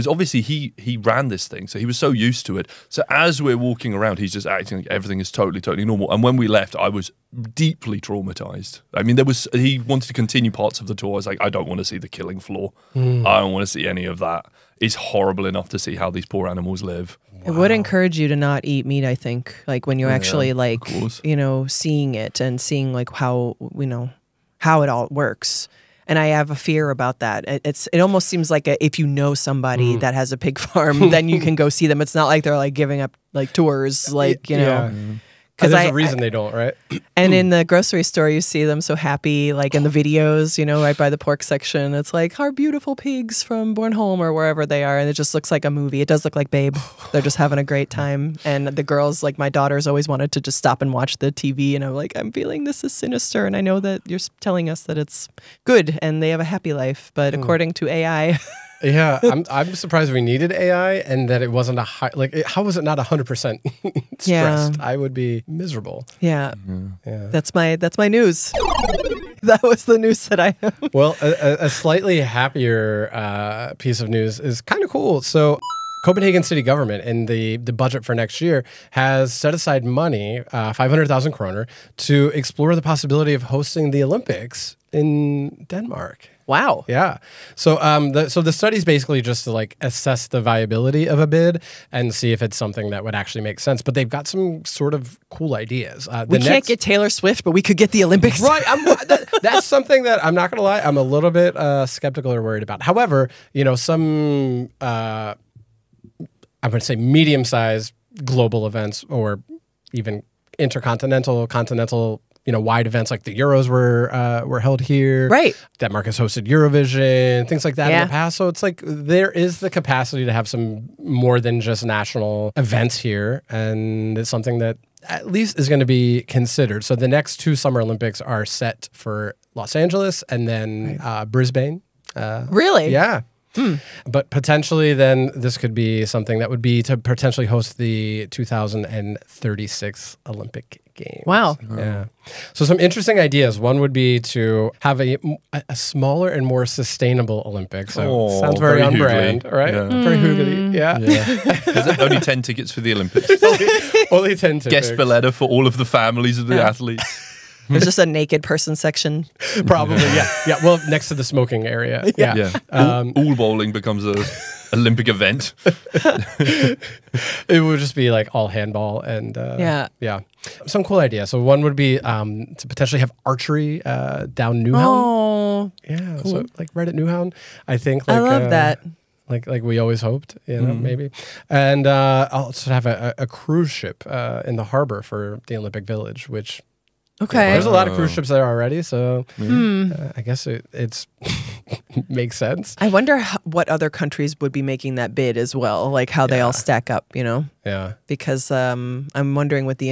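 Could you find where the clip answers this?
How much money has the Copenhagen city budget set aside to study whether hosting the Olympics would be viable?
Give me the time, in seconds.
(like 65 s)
80 s.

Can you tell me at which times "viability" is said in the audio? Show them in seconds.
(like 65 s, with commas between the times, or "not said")
90 s.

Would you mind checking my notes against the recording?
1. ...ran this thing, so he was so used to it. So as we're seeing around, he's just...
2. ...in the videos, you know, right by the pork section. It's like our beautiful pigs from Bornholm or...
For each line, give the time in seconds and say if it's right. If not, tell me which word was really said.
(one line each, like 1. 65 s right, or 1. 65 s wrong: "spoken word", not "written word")
1. 0 s wrong: "walking", not "seeing"
2. 39 s right.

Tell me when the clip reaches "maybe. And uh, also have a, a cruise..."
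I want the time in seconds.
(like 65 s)
180 s.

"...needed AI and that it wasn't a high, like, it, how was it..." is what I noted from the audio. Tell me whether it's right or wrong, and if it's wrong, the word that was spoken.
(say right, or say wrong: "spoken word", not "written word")
right.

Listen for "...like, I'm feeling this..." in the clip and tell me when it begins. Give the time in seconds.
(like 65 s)
51 s.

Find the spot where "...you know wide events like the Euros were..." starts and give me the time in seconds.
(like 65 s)
112 s.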